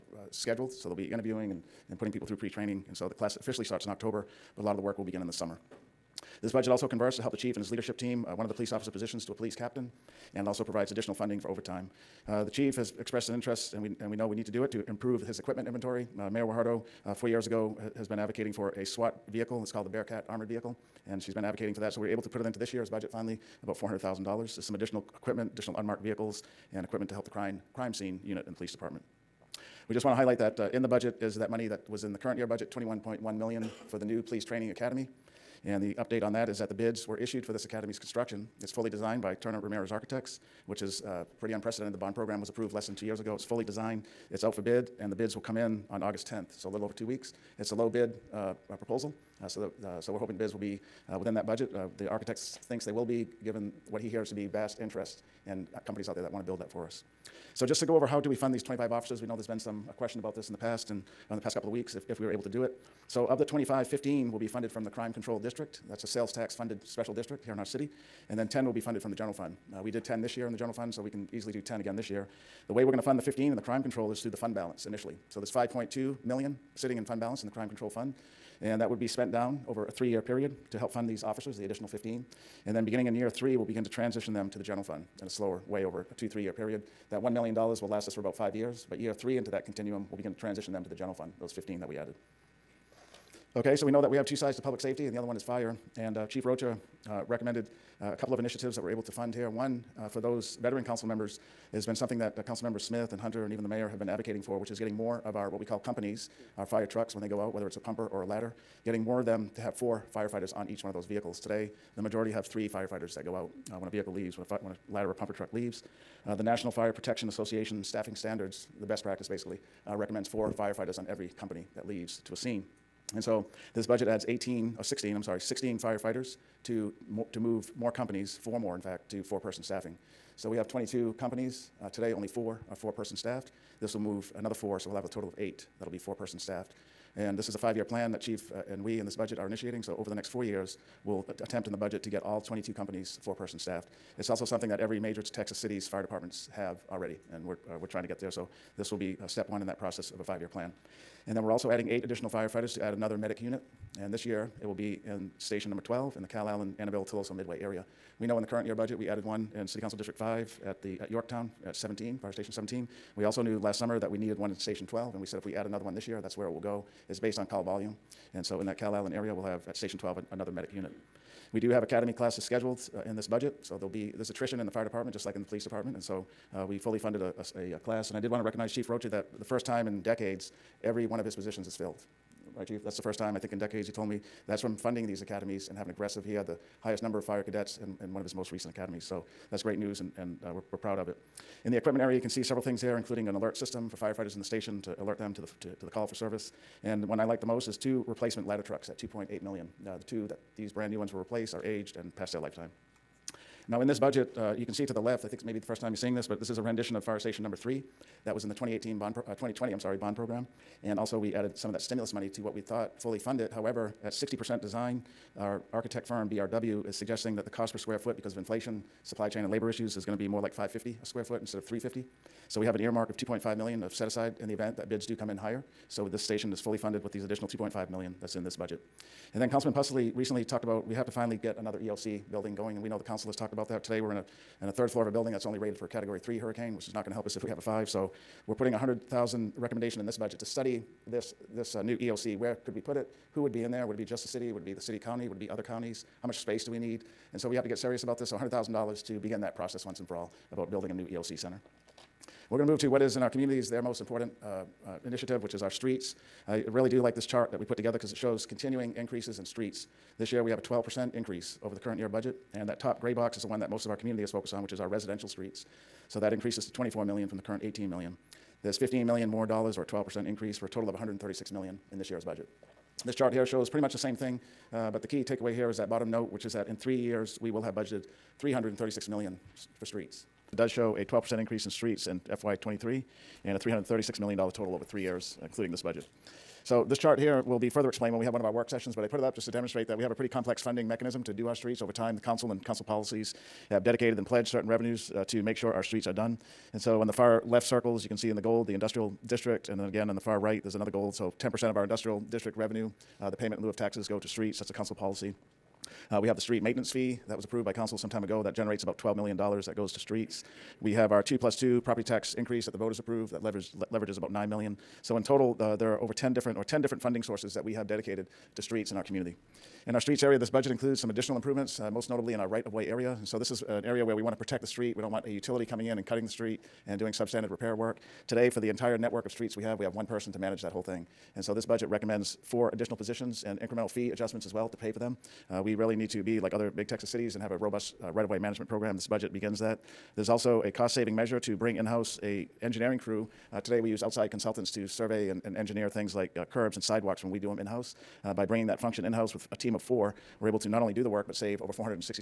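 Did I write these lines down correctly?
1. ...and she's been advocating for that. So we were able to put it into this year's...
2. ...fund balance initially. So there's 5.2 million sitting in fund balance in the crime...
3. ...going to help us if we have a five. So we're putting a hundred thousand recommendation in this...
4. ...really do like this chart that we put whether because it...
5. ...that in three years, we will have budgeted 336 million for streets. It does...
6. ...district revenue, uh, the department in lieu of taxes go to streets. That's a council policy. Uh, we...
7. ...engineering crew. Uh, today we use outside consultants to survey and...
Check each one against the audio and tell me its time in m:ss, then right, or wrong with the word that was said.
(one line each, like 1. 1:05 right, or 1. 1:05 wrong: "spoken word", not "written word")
1. 0:21 right
2. 1:14 right
3. 3:57 right
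4. 4:16 wrong: "together", not "whether"
5. 4:36 right
6. 5:02 wrong: "payment", not "department"
7. 5:42 right.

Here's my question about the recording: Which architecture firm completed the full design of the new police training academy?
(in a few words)
Turner Ramirez Architects.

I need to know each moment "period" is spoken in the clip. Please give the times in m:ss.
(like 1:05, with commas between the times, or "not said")
1:20, 1:26.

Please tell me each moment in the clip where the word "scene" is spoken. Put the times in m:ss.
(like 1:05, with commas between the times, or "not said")
0:27, 2:02.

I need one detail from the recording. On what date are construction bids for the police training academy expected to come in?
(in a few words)
August 10th.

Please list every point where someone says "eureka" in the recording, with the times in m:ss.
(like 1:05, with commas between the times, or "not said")
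not said.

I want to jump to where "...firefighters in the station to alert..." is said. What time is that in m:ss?
3:13.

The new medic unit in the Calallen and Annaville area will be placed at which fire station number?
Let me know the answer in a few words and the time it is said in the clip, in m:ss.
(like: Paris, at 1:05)
12, at 2:35.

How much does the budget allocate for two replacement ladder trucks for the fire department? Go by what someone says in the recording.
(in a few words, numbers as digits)
2.8 million.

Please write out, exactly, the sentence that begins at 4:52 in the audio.
The council and council policies have dedicated and pledged certain revenues uh, to make sure our streets are done.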